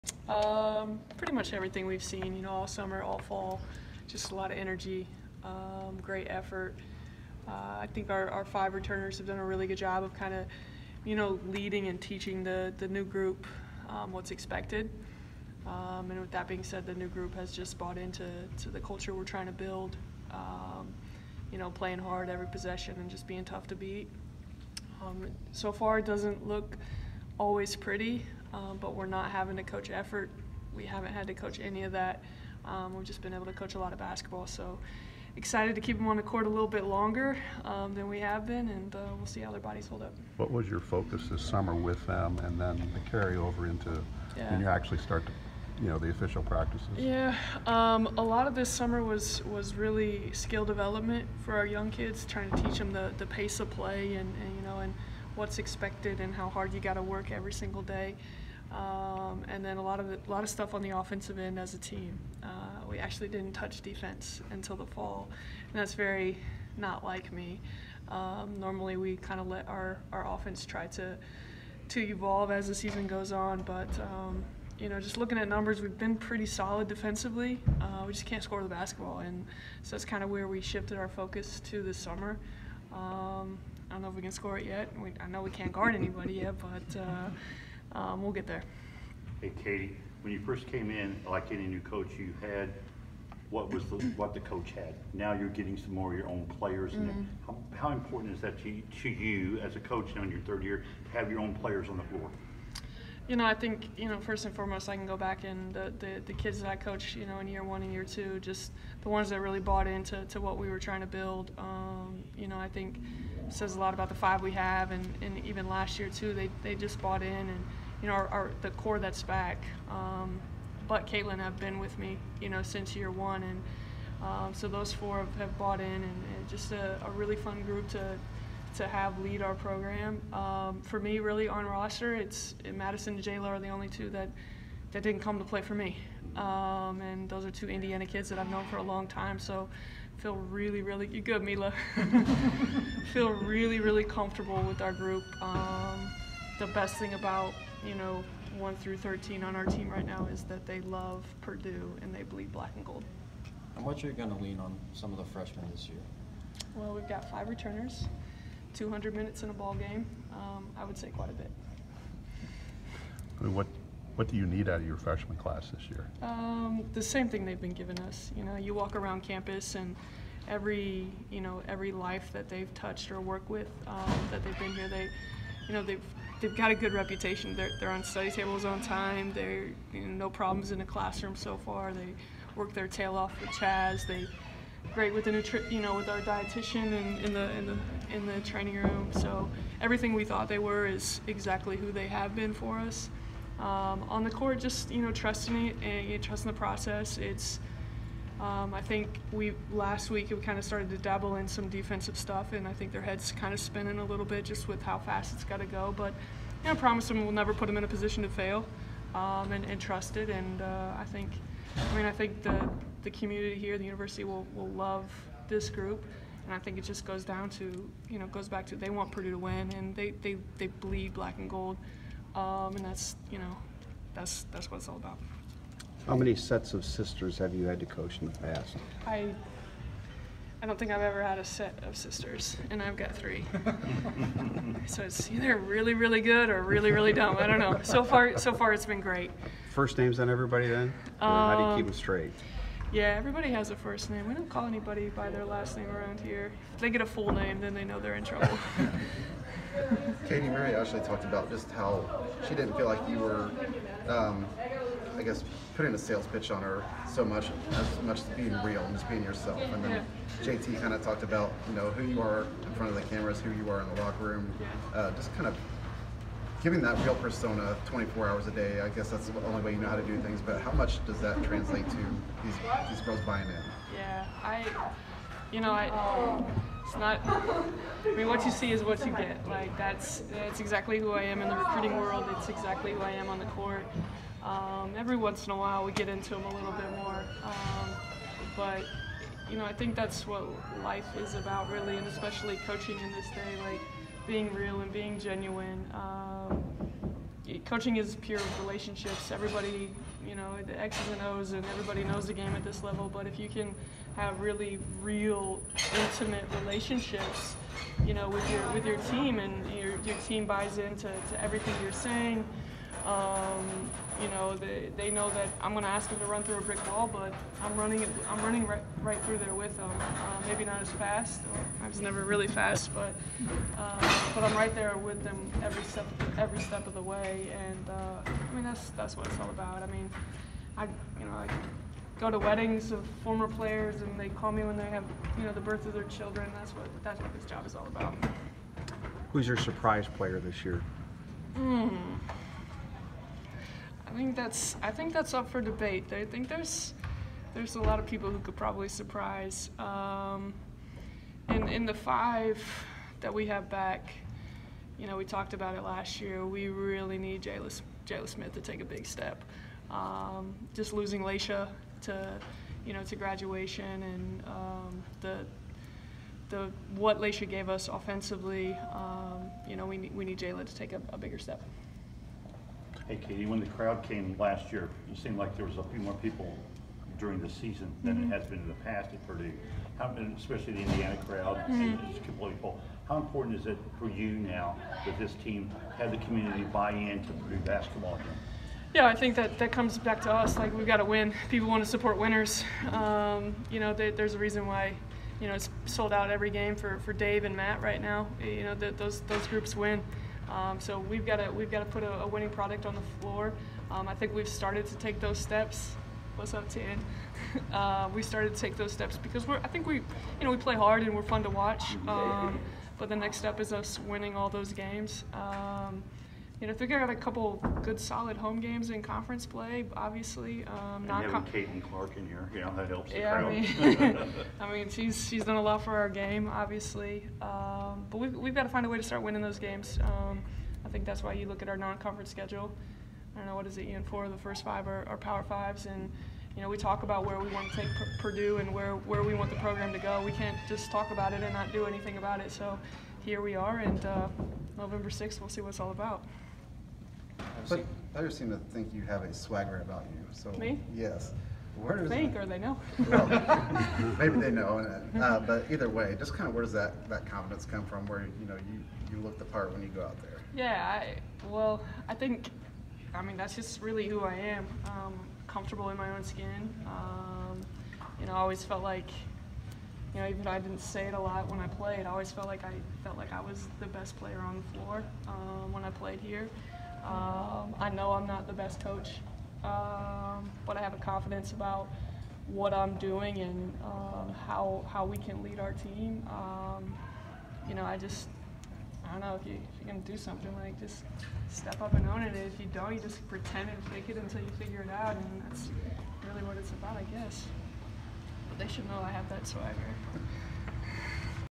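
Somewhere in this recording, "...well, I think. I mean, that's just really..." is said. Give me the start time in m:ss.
7:41.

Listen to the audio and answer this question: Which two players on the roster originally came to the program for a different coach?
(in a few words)
Madison and Jayla.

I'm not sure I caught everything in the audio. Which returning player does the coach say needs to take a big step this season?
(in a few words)
Jalen Smith.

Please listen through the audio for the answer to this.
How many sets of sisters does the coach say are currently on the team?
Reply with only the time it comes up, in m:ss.
3:53.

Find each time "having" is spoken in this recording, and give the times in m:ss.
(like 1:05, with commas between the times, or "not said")
0:29, 7:01.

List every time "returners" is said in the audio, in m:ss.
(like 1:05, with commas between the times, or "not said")
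0:08, 2:37.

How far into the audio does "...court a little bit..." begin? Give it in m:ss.
0:36.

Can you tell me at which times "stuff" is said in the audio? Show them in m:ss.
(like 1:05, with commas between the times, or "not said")
1:00, 3:22.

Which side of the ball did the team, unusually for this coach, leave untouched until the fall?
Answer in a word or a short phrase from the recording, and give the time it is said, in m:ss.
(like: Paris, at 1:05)
Defense, at 1:03.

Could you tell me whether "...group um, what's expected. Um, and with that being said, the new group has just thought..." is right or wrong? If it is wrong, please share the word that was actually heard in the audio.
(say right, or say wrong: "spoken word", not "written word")
wrong: "bought", not "thought".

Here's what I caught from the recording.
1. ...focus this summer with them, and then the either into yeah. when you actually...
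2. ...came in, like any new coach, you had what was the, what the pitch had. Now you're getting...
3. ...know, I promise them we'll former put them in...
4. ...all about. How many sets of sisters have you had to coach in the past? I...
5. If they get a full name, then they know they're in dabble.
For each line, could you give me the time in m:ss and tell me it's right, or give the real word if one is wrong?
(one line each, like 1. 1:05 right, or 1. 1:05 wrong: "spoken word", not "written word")
1. 0:40 wrong: "carryover", not "either"
2. 1:30 wrong: "coach", not "pitch"
3. 3:26 wrong: "never", not "former"
4. 3:44 right
5. 4:06 wrong: "trouble", not "dabble".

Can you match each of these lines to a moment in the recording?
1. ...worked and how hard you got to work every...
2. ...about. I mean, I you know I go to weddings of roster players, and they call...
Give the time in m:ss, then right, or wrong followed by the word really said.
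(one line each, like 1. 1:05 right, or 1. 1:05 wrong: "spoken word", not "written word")
1. 0:55 wrong: "expected", not "worked"
2. 5:29 wrong: "former", not "roster".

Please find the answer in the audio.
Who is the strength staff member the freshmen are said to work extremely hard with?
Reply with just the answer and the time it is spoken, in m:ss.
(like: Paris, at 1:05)
Chaz, at 3:03.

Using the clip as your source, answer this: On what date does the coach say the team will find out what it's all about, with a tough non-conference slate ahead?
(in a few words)
November 6.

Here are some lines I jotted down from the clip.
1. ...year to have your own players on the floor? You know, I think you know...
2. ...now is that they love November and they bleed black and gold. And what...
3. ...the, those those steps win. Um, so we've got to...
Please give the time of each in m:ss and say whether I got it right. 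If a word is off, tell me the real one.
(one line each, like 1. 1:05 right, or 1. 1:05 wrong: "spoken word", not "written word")
1. 1:40 right
2. 2:30 wrong: "Purdue", not "November"
3. 6:38 wrong: "groups", not "steps".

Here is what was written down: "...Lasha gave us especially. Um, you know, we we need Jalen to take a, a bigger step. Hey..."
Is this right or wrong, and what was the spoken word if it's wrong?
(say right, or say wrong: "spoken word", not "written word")
wrong: "offensively", not "especially".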